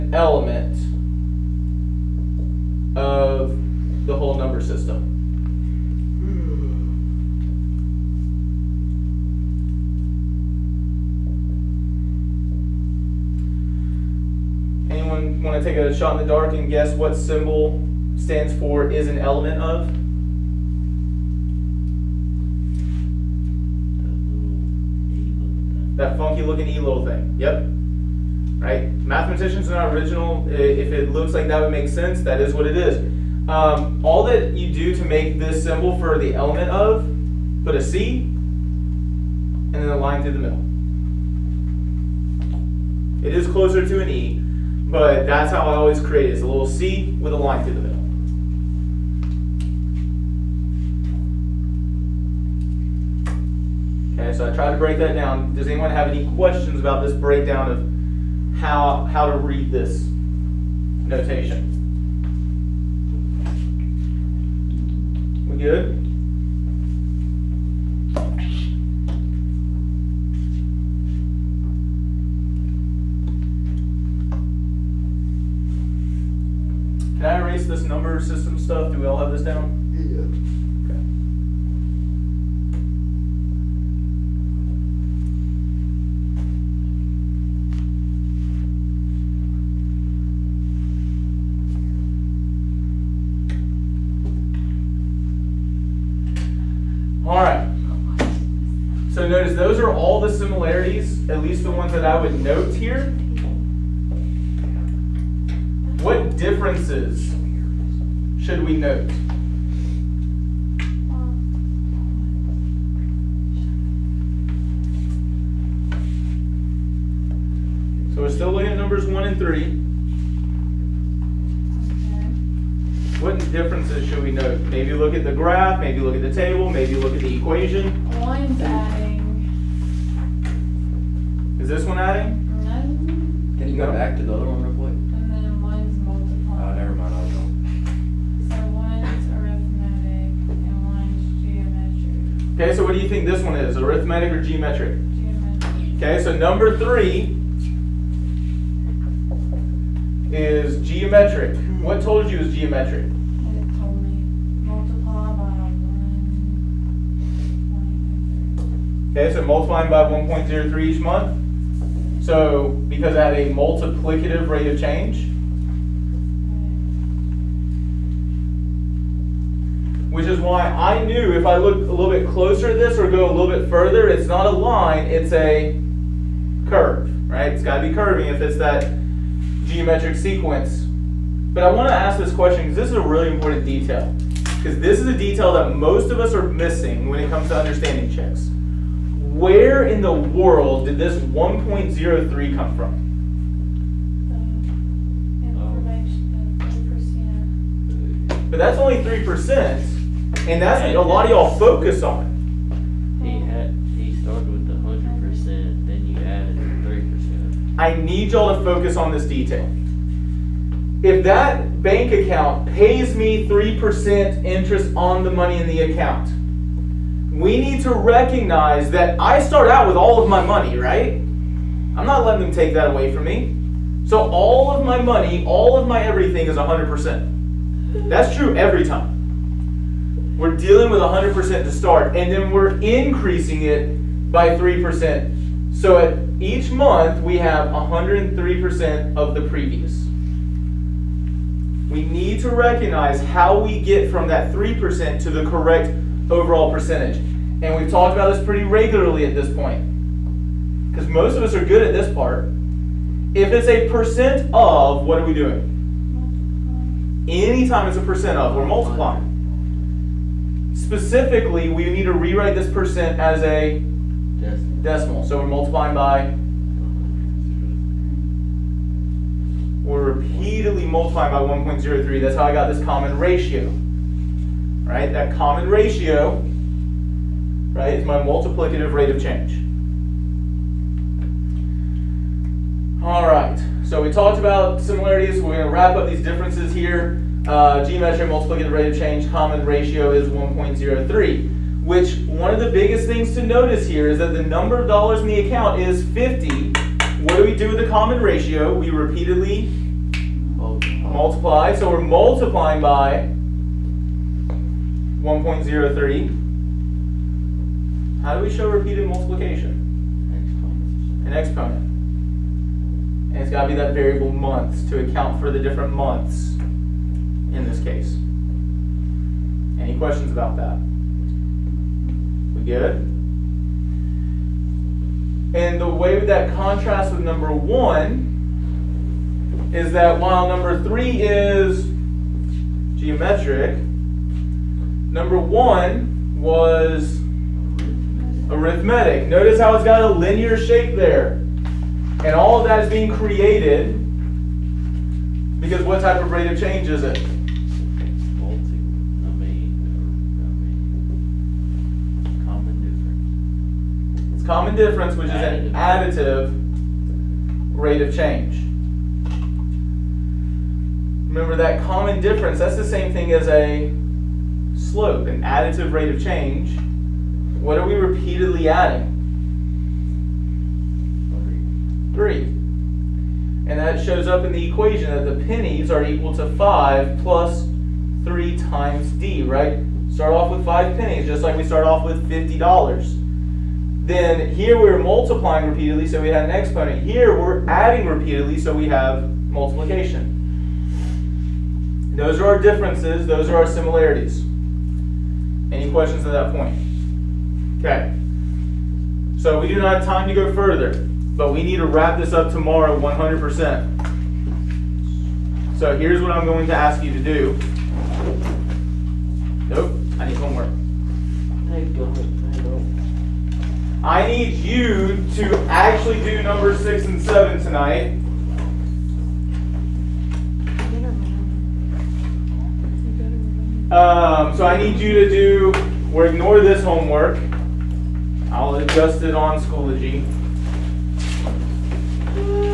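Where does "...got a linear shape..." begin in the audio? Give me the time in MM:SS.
05:39.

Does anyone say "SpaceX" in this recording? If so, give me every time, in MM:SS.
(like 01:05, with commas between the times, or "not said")
not said.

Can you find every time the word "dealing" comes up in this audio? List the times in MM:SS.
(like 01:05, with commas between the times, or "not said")
03:50.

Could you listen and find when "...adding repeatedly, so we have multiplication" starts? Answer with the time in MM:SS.
06:27.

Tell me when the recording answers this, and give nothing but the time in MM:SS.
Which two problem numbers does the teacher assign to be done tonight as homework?
06:56.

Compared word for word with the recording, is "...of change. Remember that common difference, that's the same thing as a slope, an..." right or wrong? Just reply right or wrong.
right.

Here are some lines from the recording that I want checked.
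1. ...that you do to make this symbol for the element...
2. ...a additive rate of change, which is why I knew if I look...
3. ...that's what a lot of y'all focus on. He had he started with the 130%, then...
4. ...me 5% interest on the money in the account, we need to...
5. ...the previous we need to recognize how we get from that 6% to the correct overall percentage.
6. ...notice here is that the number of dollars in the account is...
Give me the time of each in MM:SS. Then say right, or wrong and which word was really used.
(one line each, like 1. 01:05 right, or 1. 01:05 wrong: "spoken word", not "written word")
1. 00:34 right
2. 02:43 wrong: "multiplicative", not "additive"
3. 03:20 wrong: "100", not "130"
4. 03:33 wrong: "3", not "5"
5. 03:59 wrong: "3", not "6"
6. 04:53 right.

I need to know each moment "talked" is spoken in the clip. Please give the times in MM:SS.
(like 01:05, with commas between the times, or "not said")
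04:07, 04:44.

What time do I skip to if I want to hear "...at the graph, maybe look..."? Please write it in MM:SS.
02:05.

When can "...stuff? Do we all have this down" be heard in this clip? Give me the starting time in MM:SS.
01:18.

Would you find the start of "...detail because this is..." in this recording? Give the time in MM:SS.
03:03.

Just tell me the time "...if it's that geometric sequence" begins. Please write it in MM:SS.
02:58.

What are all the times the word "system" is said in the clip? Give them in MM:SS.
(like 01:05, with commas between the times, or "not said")
00:04, 01:18.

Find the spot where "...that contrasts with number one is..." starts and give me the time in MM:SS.
05:26.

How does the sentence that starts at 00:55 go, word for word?
Does anyone have any questions about this breakdown of how, how to read this notation?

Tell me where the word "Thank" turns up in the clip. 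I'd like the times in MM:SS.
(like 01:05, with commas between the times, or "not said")
06:51.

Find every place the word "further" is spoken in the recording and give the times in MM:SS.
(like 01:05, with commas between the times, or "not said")
02:53, 06:40.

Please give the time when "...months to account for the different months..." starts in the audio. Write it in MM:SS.
05:14.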